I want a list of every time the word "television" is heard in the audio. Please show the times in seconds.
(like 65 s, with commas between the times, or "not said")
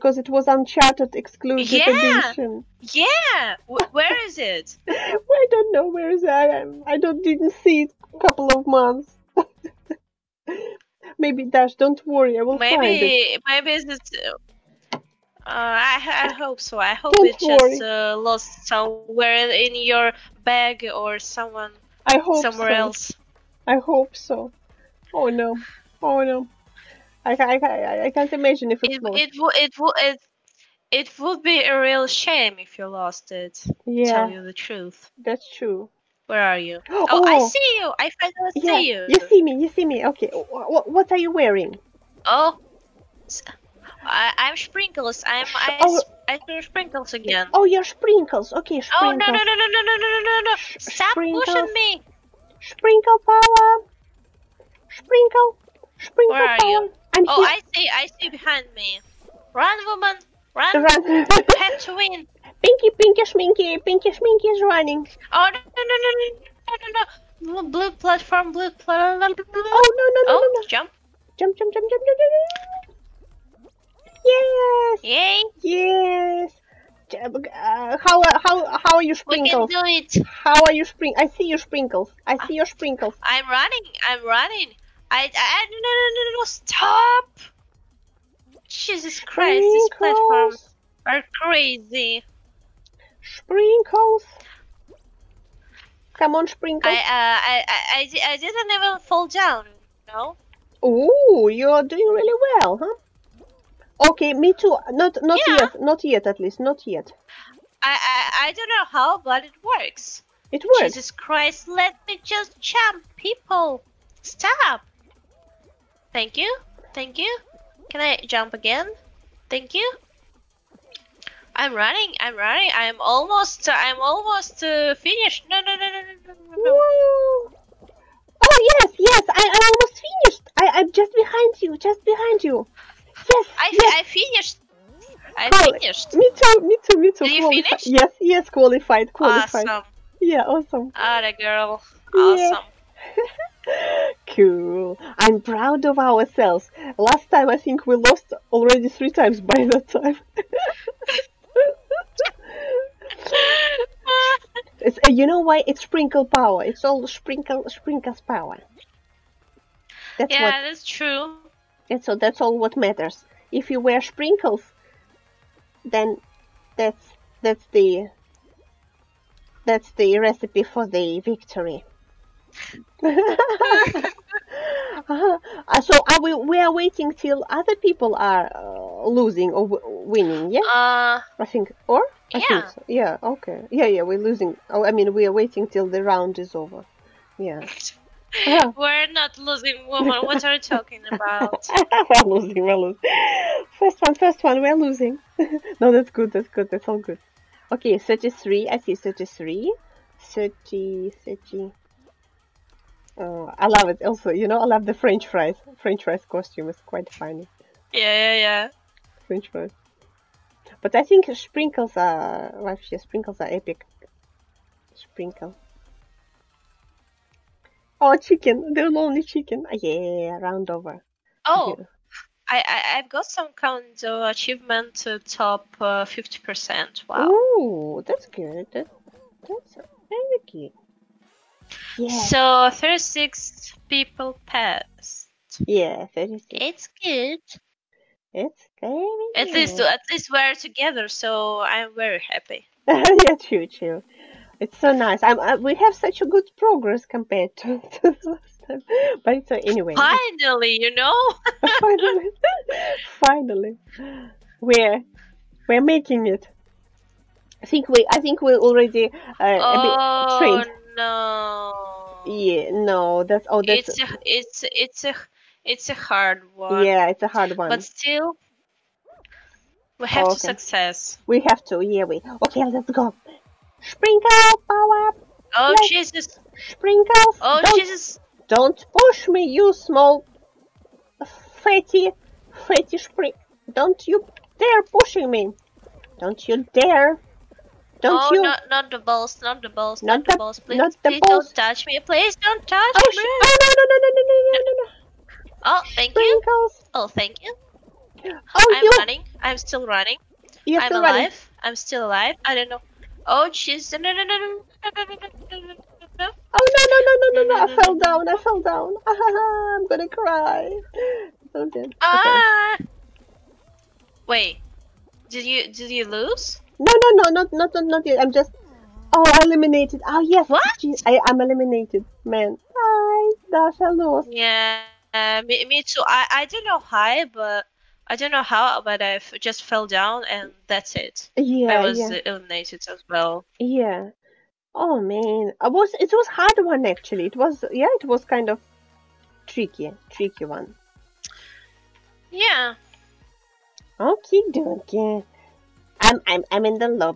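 not said.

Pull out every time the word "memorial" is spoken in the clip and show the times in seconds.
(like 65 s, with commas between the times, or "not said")
not said.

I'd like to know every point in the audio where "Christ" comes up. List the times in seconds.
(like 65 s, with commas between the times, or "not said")
89 s, 111 s.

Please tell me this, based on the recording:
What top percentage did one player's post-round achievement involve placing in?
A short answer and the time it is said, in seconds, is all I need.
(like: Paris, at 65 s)
50%, at 226 s.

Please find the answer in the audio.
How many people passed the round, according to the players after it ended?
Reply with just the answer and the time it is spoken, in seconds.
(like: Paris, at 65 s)
36, at 232 s.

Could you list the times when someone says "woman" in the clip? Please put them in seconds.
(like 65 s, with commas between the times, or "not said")
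59 s, 189 s.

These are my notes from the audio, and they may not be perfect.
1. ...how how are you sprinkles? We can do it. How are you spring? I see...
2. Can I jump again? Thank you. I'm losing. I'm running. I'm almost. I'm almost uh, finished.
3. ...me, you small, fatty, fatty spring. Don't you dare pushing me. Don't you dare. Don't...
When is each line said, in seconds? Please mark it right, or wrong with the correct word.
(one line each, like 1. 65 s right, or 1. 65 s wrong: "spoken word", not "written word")
1. 78 s right
2. 117 s wrong: "running", not "losing"
3. 279 s right.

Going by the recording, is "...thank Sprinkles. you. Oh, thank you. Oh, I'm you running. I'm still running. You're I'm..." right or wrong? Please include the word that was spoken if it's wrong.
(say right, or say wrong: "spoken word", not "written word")
right.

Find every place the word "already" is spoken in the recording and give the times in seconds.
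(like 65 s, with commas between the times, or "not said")
148 s, 258 s.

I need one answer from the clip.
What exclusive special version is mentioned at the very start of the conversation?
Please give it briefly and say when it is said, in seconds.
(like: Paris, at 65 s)
Uncharted, at 0 s.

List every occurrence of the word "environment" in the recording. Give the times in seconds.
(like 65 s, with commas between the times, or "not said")
not said.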